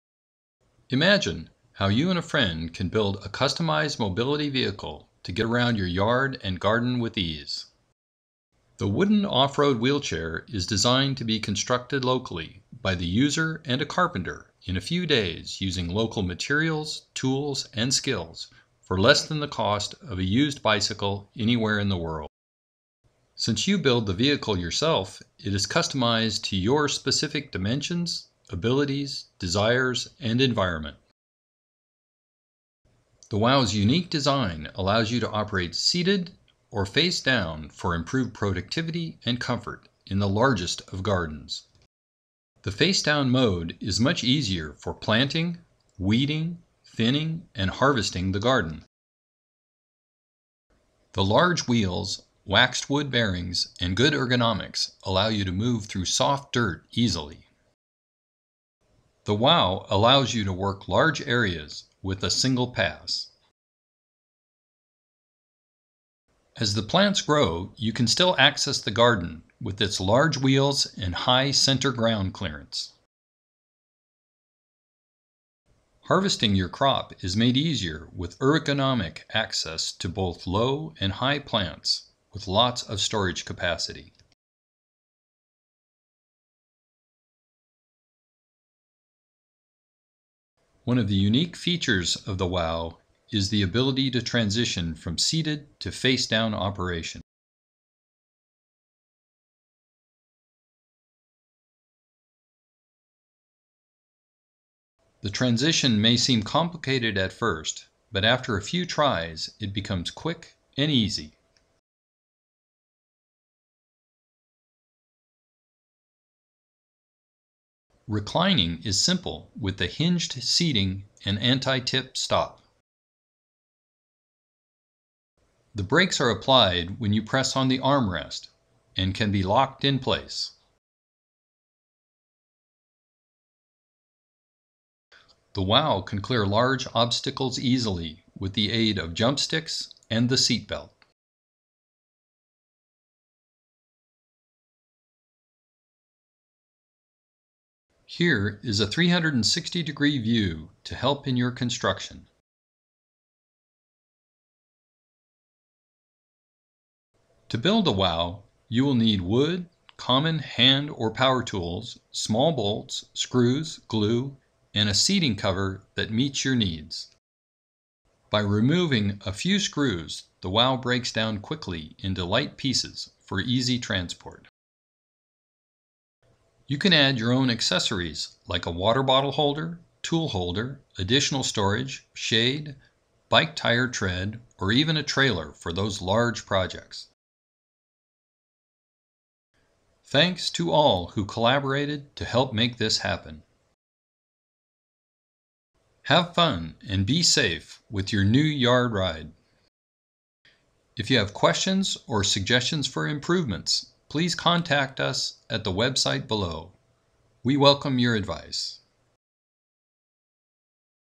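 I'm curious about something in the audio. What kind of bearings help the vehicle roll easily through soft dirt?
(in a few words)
Waxed wood bearings.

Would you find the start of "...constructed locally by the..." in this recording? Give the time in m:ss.
0:11.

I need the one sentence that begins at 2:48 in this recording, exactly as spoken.
By removing a few screws, the WOW breaks down quickly into light pieces for easy transport.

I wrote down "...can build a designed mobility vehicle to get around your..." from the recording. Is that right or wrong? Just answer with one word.
wrong.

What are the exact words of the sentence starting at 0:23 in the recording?
Since you build the vehicle yourself, it is customized to your specific dimensions, abilities, desires, and environment.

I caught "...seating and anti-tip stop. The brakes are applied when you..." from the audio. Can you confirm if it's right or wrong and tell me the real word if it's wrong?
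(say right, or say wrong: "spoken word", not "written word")
right.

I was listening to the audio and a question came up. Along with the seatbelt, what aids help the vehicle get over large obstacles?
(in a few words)
Jump sticks.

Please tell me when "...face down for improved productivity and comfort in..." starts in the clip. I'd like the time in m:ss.
0:36.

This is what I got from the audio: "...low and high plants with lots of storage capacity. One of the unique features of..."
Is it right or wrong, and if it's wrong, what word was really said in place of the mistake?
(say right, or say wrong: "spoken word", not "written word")
right.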